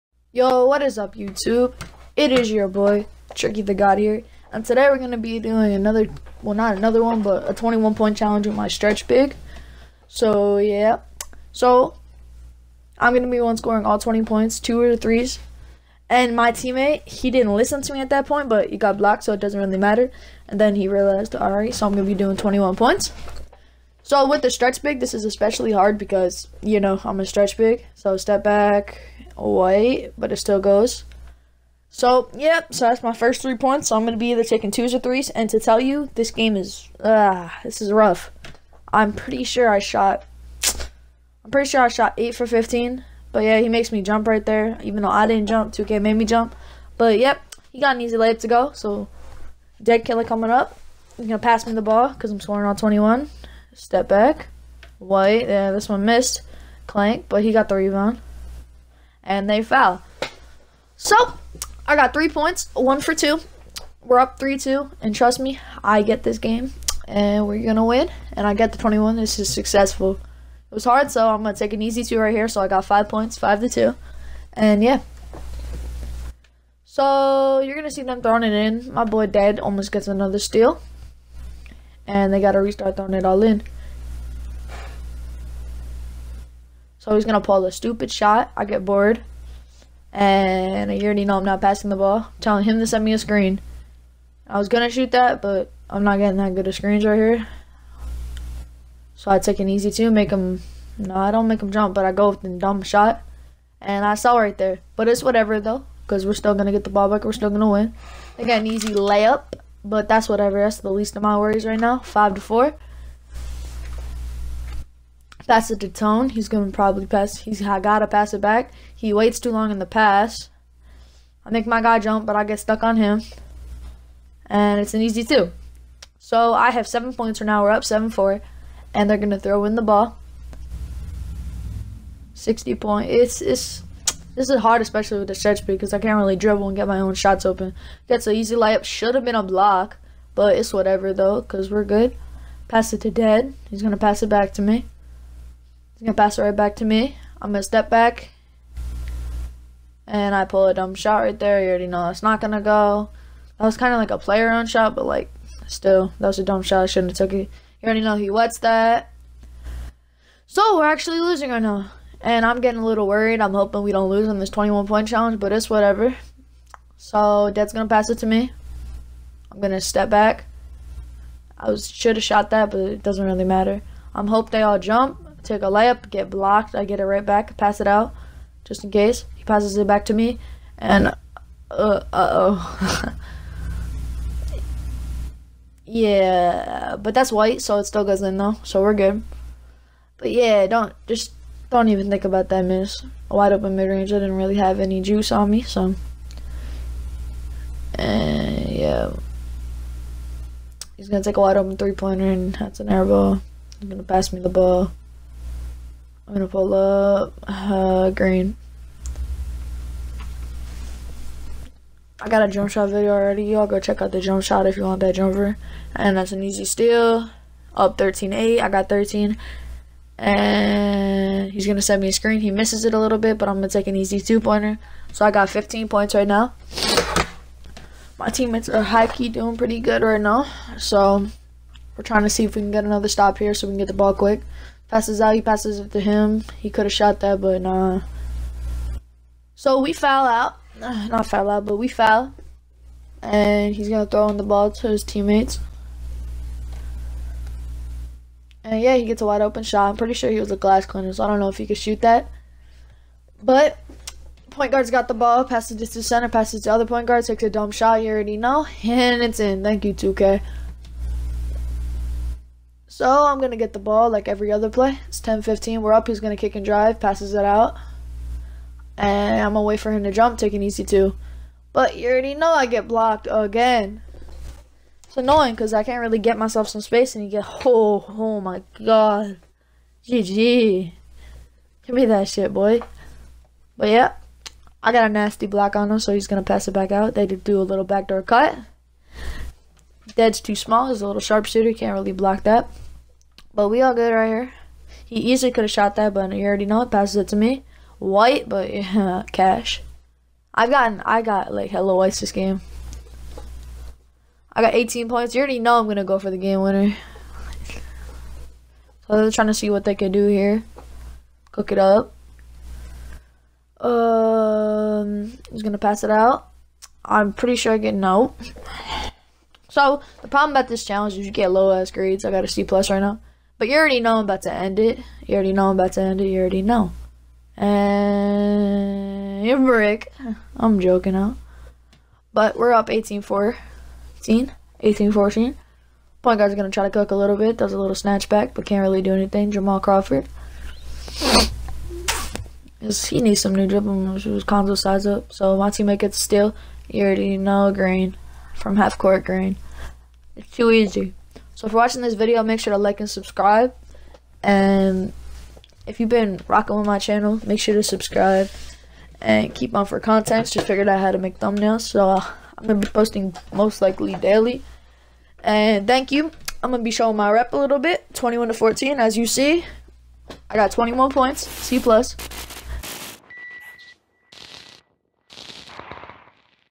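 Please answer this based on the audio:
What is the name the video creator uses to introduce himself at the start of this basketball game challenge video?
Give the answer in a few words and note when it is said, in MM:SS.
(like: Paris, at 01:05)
Tricky the God, at 00:03.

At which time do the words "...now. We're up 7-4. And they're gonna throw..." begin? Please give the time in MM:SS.
02:07.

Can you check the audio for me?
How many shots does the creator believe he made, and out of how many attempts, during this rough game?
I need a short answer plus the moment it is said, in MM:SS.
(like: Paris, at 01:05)
8 for 15, at 00:42.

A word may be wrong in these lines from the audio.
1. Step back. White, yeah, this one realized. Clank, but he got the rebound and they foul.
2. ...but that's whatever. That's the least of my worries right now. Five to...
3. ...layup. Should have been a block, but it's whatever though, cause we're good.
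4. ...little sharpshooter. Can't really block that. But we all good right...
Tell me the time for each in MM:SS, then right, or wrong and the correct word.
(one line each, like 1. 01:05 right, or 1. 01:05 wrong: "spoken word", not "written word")
1. 00:53 wrong: "missed", not "realized"
2. 01:49 right
3. 02:18 right
4. 04:51 right.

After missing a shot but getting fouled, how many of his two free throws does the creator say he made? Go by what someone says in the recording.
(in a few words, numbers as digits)
1 for 2.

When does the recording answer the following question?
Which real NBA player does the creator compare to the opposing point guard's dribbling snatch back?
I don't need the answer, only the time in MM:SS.
05:39.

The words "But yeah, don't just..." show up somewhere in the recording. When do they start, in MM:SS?
03:10.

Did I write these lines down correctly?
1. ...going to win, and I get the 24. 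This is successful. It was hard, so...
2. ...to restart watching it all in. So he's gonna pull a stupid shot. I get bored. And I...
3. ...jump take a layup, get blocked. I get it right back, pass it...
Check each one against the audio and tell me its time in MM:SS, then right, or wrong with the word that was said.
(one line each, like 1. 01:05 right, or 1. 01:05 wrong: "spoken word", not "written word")
1. 01:07 wrong: "21", not "24"
2. 01:22 wrong: "throwing", not "watching"
3. 02:54 right.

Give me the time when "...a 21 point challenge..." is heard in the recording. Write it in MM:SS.
00:07.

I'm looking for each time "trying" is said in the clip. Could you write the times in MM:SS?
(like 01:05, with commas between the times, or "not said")
03:52, 05:09.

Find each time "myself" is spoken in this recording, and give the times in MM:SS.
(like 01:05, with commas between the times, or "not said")
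04:36.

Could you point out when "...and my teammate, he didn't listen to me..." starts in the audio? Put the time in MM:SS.
00:16.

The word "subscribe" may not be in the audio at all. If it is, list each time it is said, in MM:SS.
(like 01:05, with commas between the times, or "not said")
05:53, 05:57.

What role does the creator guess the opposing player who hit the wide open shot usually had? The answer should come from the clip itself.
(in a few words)
glass cleaner.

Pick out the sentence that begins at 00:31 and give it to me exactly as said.
So, yep, so that's my first three points.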